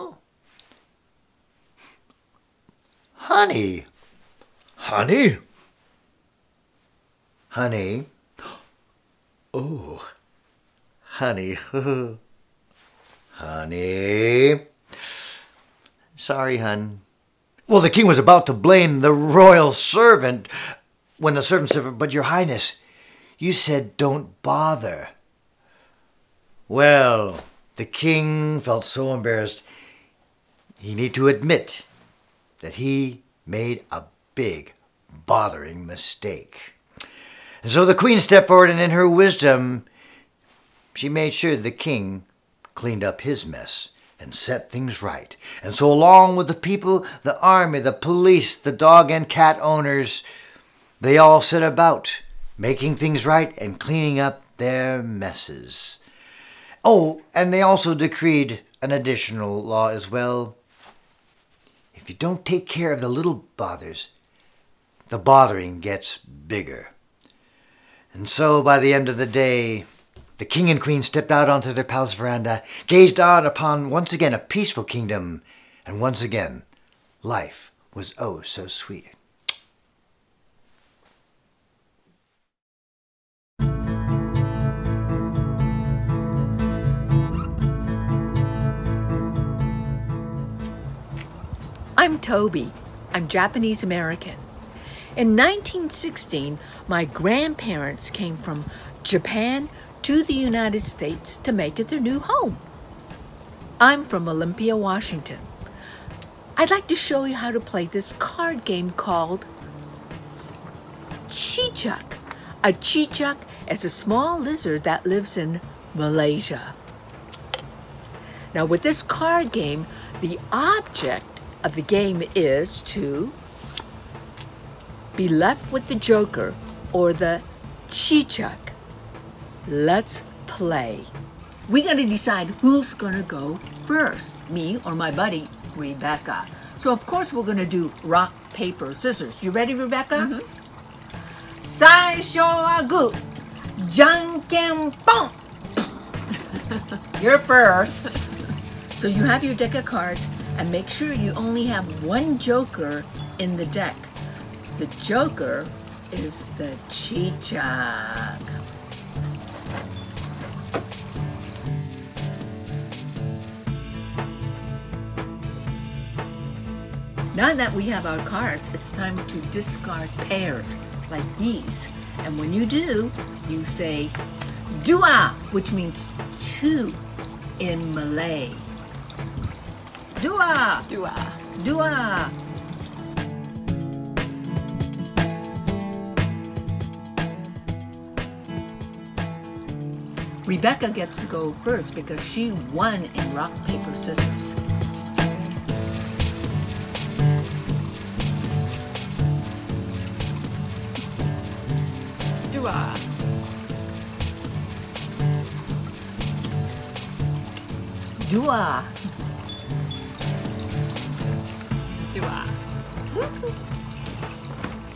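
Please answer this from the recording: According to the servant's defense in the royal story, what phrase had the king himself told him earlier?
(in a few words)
don't bother.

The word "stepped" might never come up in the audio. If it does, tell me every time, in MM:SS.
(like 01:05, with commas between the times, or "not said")
00:38, 01:11.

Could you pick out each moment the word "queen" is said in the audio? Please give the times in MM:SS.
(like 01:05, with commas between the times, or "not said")
00:37, 01:10.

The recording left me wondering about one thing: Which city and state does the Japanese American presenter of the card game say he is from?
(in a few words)
Olympia, Washington.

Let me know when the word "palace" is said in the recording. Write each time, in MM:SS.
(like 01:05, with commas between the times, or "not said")
01:11.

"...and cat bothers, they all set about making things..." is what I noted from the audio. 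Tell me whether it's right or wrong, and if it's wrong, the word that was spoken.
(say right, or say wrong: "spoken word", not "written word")
wrong: "owners", not "bothers".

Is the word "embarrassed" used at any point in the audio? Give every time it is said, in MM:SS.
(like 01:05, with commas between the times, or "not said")
00:29.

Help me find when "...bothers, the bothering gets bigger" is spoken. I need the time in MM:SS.
01:03.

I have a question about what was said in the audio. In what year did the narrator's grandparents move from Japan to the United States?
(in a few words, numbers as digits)
1916.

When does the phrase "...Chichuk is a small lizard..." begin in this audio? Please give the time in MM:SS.
01:52.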